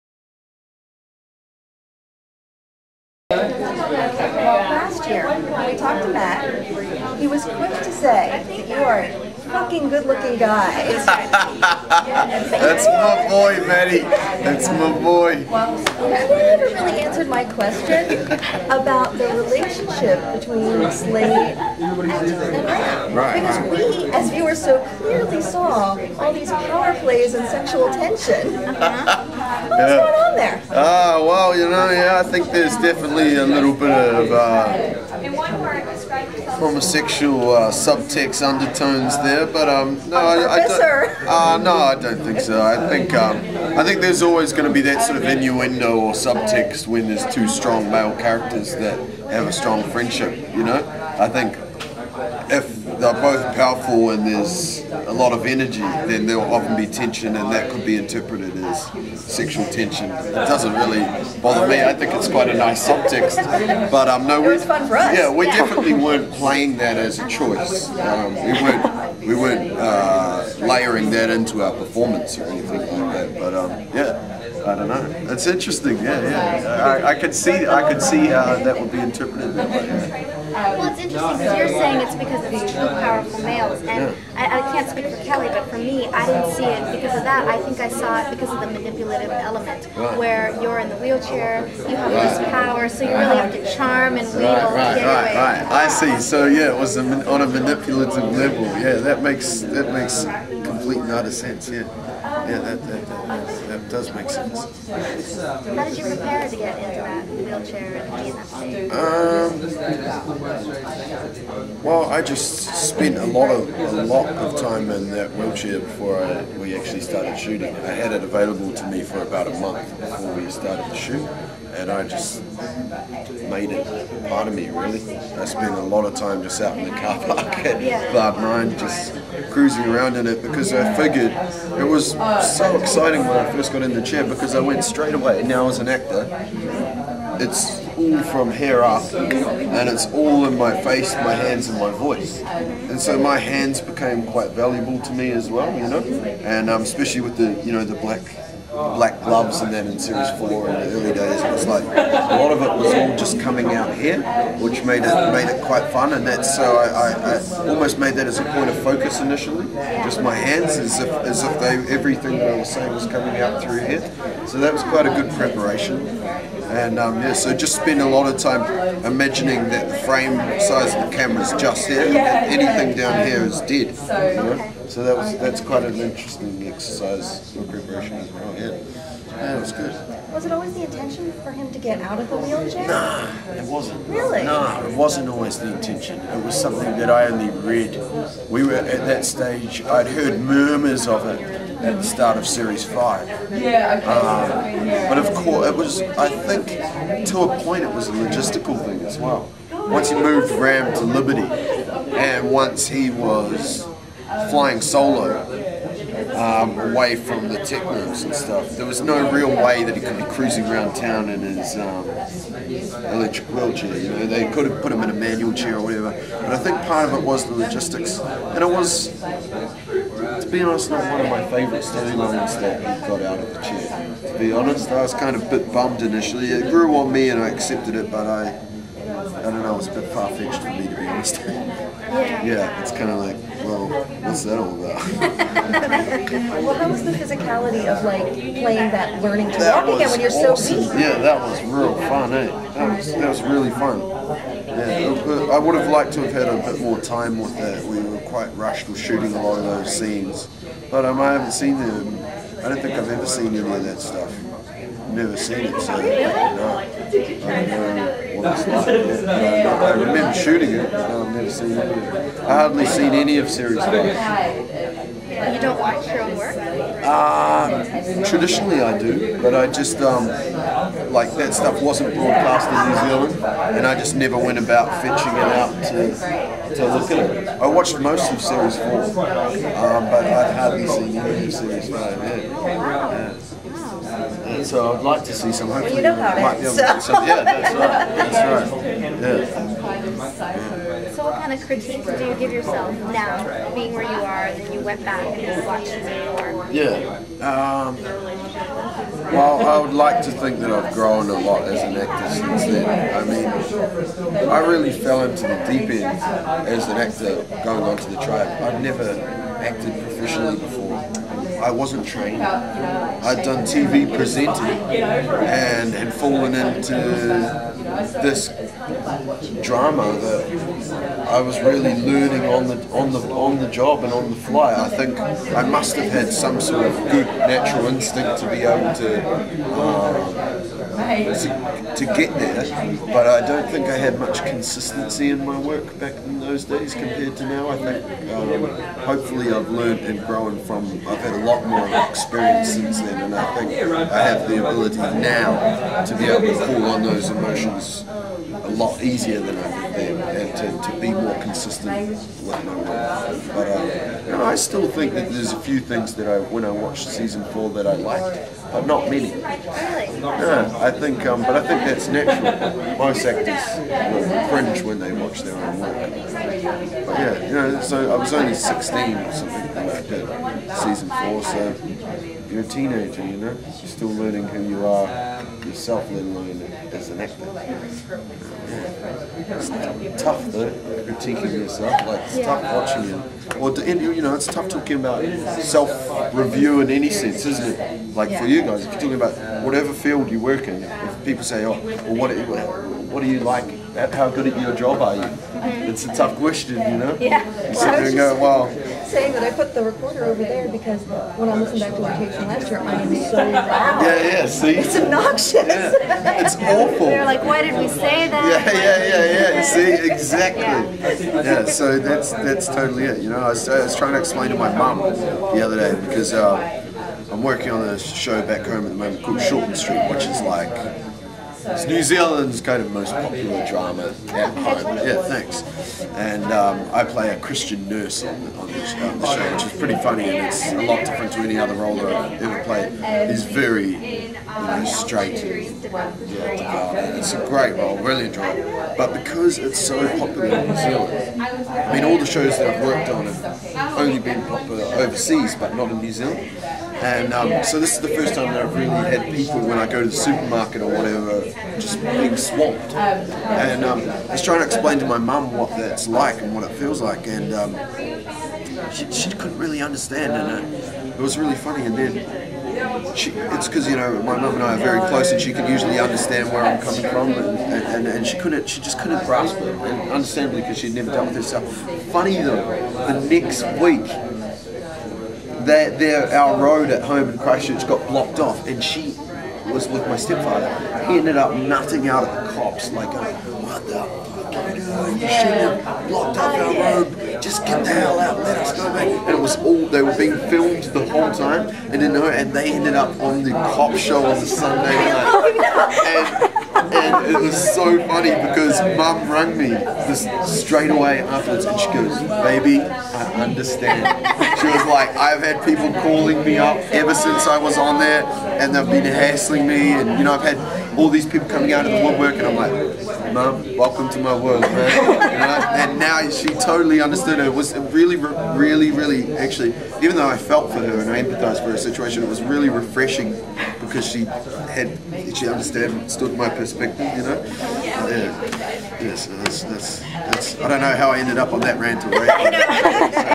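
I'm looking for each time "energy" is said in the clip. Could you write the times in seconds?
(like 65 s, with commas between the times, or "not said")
55 s.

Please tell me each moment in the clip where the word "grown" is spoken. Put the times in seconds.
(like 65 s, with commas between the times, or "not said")
300 s, 340 s.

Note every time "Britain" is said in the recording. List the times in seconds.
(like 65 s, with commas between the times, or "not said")
not said.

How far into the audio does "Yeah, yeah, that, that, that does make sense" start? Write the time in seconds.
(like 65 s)
101 s.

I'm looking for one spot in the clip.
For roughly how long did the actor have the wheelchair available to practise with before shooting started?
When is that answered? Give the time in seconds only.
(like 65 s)
119 s.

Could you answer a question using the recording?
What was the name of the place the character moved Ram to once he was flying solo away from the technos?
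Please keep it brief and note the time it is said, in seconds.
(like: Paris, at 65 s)
Liberty, at 201 s.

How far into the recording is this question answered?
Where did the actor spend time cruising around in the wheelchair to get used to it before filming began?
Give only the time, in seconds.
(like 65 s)
126 s.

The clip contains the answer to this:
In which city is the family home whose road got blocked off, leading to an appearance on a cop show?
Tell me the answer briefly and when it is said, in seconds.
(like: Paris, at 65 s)
Christchurch, at 477 s.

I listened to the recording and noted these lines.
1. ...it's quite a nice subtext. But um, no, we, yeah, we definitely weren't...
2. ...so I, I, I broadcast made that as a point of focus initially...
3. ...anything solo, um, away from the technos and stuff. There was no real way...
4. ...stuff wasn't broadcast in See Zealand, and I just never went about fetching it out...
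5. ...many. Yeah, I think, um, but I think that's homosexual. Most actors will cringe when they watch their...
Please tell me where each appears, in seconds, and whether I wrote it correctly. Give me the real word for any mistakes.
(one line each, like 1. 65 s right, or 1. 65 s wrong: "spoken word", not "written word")
1. 62 s right
2. 156 s wrong: "almost", not "broadcast"
3. 204 s wrong: "flying", not "anything"
4. 271 s wrong: "New", not "See"
5. 359 s wrong: "natural", not "homosexual".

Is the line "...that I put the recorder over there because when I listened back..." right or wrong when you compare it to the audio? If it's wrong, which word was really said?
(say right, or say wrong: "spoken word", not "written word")
right.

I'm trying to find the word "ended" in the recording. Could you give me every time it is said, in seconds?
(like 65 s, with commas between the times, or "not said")
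481 s, 492 s, 531 s.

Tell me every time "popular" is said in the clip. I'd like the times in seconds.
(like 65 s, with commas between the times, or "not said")
423 s, 440 s, 444 s.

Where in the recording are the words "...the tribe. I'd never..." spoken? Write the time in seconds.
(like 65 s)
308 s.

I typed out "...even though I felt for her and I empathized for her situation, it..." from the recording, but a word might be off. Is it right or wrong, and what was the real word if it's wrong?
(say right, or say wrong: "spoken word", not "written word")
right.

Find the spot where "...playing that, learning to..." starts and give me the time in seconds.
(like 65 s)
238 s.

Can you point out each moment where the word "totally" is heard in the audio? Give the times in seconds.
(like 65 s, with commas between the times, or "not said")
412 s, 516 s.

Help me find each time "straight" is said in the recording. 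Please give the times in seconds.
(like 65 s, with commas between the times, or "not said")
134 s, 434 s, 500 s.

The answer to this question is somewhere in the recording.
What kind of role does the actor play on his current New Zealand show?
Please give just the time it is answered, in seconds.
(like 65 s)
427 s.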